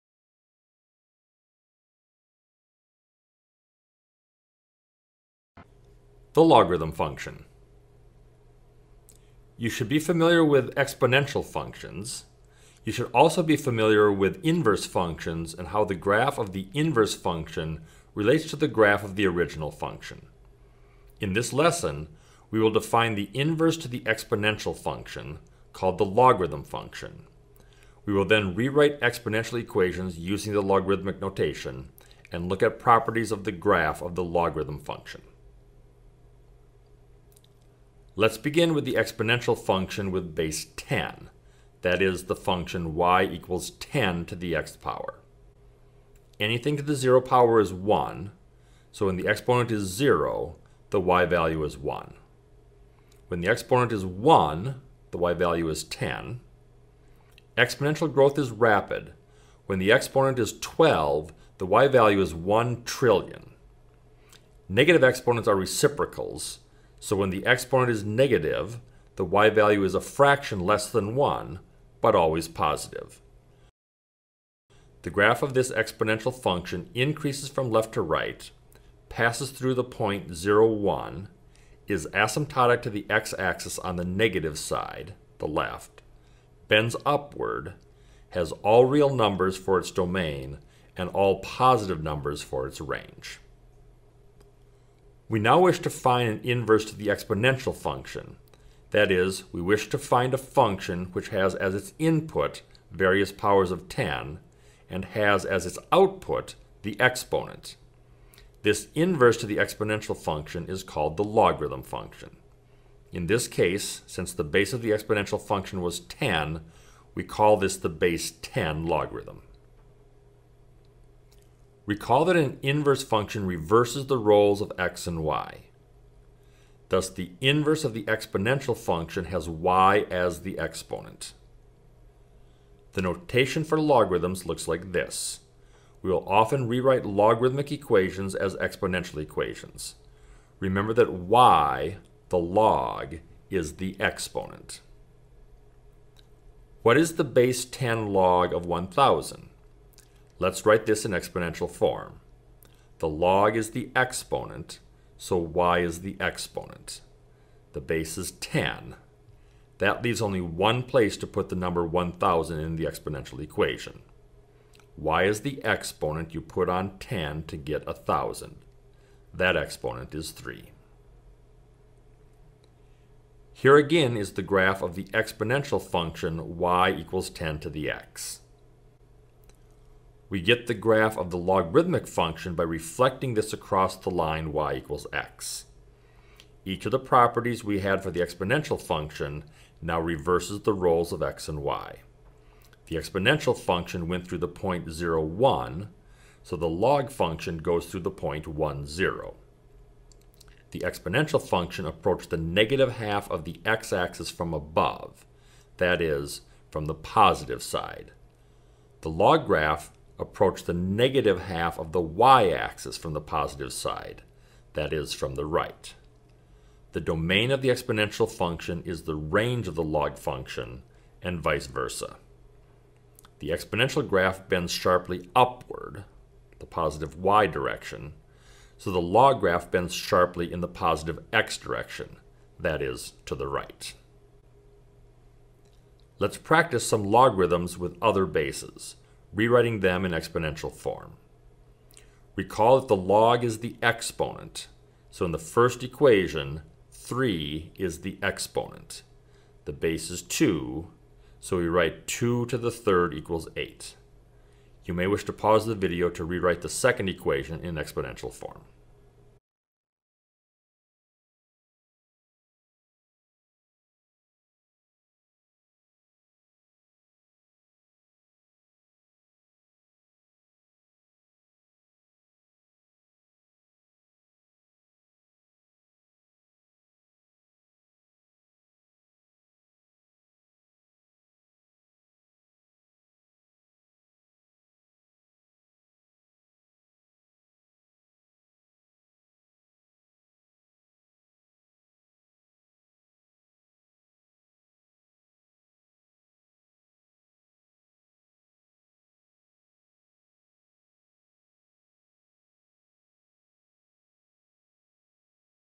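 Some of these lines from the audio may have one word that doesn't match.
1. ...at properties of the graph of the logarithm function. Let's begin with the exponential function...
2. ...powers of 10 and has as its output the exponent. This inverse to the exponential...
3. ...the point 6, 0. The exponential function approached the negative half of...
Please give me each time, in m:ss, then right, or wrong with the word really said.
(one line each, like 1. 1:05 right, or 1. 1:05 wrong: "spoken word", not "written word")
1. 0:32 right
2. 1:43 right
3. 3:17 wrong: "1", not "6".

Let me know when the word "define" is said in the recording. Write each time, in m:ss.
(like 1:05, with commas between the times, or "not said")
0:22.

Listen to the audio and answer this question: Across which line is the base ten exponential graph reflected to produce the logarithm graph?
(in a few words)
y equals x.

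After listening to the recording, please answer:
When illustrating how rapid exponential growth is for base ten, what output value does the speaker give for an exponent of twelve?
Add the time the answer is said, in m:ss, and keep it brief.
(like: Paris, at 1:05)
1 trillion, at 1:02.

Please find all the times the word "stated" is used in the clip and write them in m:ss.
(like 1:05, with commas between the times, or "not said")
not said.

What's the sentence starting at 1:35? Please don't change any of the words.
We now wish to find an inverse to the exponential function.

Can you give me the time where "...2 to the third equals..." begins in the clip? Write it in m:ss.
4:12.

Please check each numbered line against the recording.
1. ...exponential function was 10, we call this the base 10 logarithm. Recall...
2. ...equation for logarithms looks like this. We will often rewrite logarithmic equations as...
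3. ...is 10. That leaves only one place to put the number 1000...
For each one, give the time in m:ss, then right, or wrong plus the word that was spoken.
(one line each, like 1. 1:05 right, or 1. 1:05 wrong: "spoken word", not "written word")
1. 1:54 right
2. 2:13 wrong: "notation", not "equation"
3. 2:38 right.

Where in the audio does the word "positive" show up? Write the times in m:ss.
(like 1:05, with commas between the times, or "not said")
1:12, 1:31, 3:26, 3:33, 3:46, 3:50.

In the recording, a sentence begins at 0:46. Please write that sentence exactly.
Anything to the 0 power is 1, so when the exponent is 0, the y value is 1.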